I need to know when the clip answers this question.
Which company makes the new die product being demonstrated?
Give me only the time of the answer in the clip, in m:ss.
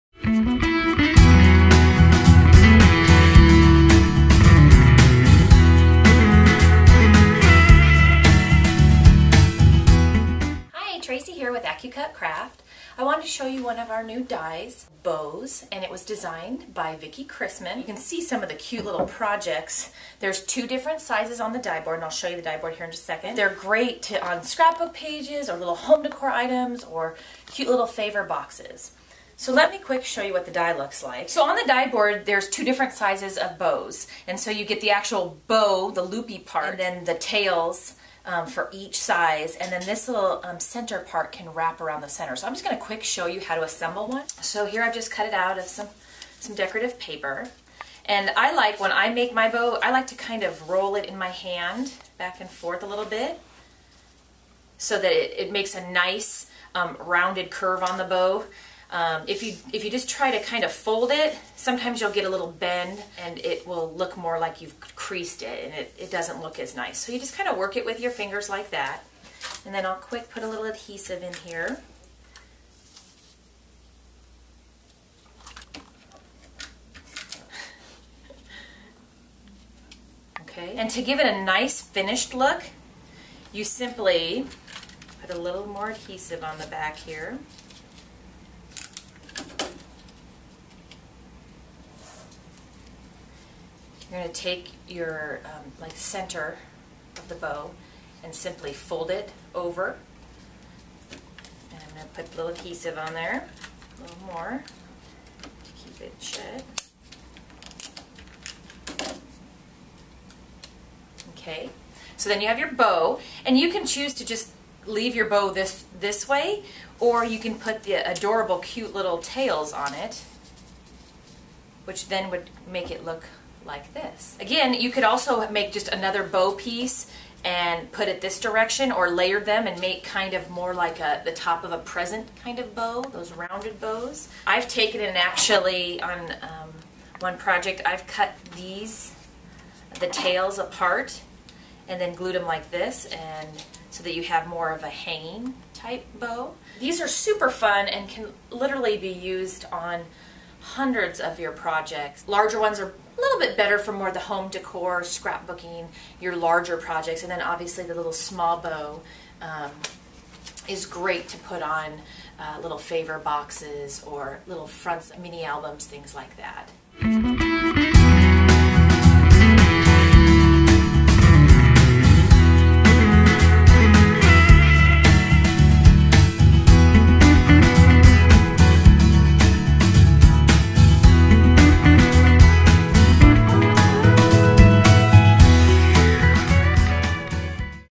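0:11.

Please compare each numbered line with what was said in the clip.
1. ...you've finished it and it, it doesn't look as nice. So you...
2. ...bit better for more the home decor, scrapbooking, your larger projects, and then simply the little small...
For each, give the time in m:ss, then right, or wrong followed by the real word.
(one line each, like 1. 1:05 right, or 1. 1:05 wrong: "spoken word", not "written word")
1. 1:04 wrong: "creased", not "finished"
2. 2:33 wrong: "obviously", not "simply".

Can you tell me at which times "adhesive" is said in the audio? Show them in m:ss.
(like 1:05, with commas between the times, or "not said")
1:10, 1:25, 1:42.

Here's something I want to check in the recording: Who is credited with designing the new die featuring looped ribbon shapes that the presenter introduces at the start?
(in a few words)
Vicki Chrisman.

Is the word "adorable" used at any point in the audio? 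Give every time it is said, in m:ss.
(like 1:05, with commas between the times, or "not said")
1:57.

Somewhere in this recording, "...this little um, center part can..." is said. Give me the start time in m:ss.
0:39.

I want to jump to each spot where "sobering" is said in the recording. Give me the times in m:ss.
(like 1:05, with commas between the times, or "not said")
not said.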